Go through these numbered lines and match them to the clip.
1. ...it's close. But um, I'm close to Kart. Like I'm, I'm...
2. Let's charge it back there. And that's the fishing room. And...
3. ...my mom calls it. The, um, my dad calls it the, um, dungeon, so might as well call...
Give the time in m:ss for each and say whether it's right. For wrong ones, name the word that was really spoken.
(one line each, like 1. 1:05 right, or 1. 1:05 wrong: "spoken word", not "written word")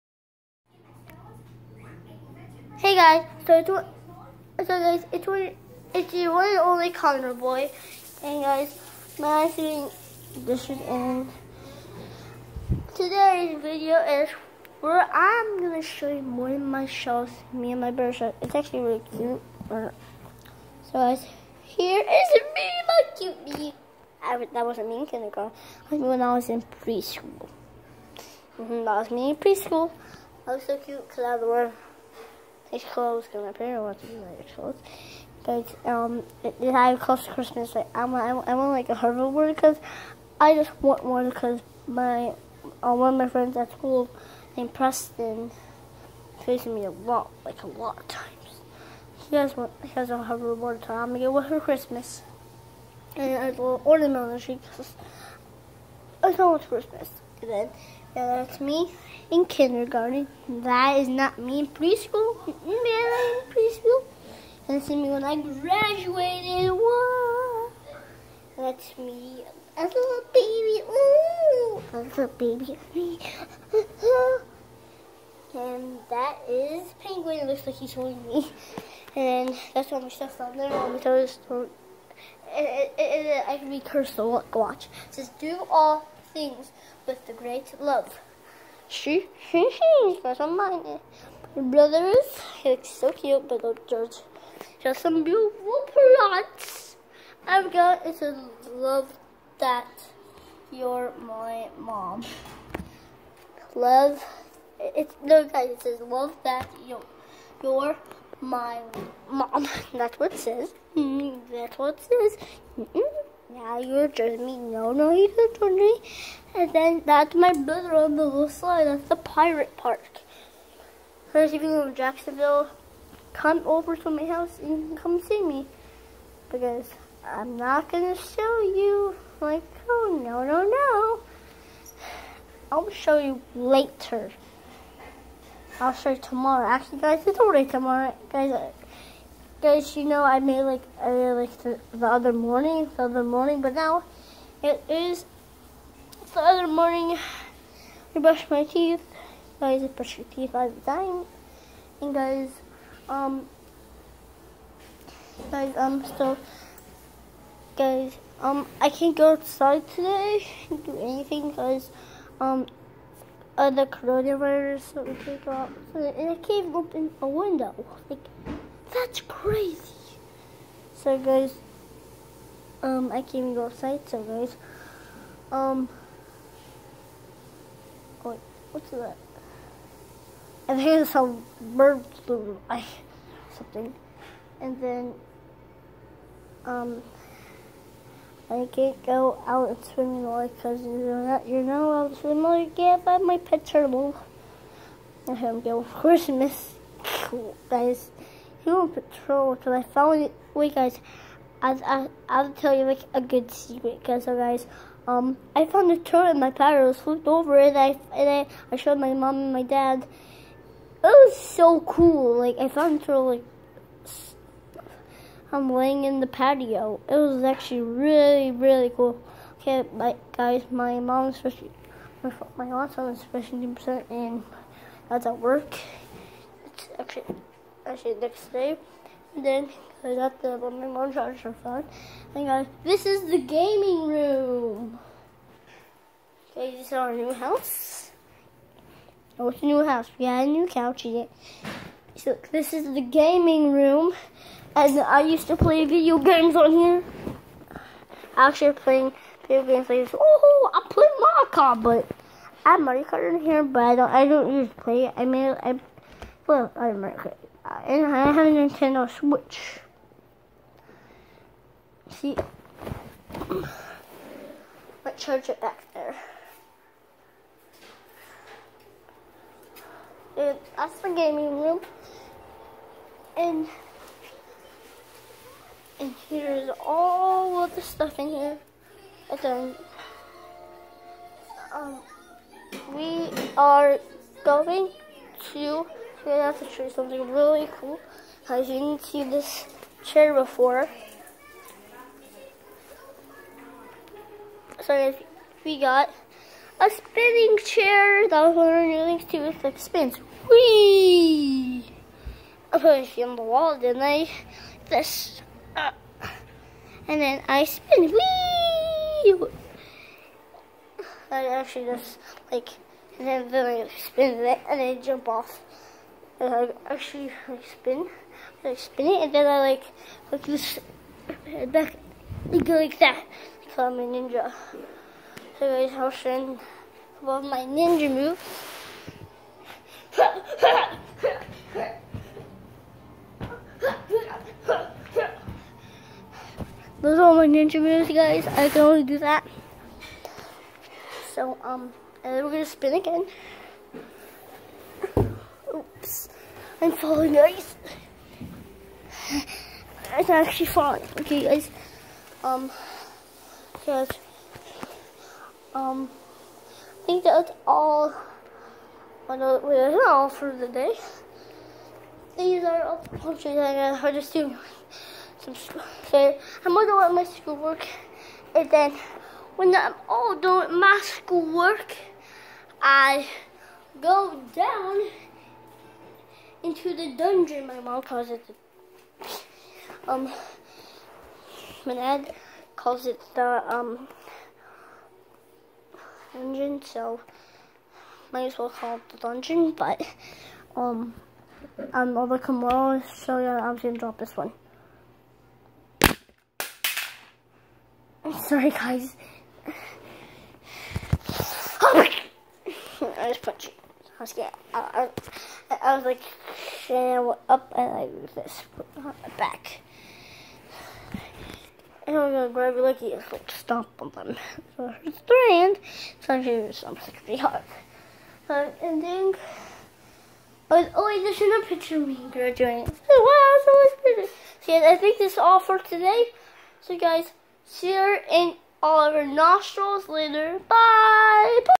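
1. 0:34 wrong: "Christmas", not "Kart"
2. 4:25 wrong: "gaming", not "fishing"
3. 6:17 right.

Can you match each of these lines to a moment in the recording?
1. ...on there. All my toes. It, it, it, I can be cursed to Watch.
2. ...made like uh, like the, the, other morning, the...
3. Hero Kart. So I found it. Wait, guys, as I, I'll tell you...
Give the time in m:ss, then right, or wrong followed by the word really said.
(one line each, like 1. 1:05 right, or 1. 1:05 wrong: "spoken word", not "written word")
1. 1:20 right
2. 2:20 right
3. 3:18 wrong: "Patrol", not "Kart".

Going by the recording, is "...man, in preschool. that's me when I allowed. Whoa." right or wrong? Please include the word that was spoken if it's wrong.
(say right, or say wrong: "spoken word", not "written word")
wrong: "graduated", not "allowed".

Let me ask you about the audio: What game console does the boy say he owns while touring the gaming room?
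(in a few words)
Nintendo Switch.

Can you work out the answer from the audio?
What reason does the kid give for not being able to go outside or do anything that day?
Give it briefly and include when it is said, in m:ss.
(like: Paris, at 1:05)
coronavirus, at 2:43.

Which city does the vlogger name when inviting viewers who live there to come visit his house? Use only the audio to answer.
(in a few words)
Jacksonville.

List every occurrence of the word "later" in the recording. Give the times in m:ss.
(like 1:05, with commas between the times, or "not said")
2:13, 7:10.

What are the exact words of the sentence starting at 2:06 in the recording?
Because I'm not going to show you.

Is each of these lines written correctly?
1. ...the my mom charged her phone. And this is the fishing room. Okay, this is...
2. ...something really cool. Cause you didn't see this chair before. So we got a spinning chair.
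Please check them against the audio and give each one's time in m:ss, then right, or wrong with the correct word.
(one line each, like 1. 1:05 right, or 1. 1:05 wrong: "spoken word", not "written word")
1. 3:50 wrong: "gaming", not "fishing"
2. 4:46 right.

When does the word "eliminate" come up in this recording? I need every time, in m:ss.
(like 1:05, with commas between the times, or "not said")
not said.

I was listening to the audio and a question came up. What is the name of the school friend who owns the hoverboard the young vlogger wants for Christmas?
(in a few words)
Preston.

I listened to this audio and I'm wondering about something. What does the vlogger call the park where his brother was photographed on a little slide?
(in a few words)
the pirate park.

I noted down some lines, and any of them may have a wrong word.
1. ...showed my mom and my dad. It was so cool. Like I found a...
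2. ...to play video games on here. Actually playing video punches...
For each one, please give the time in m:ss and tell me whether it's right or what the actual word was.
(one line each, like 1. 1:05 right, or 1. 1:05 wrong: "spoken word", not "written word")
1. 3:28 right
2. 4:05 wrong: "games", not "punches".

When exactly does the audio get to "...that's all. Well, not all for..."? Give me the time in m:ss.
5:57.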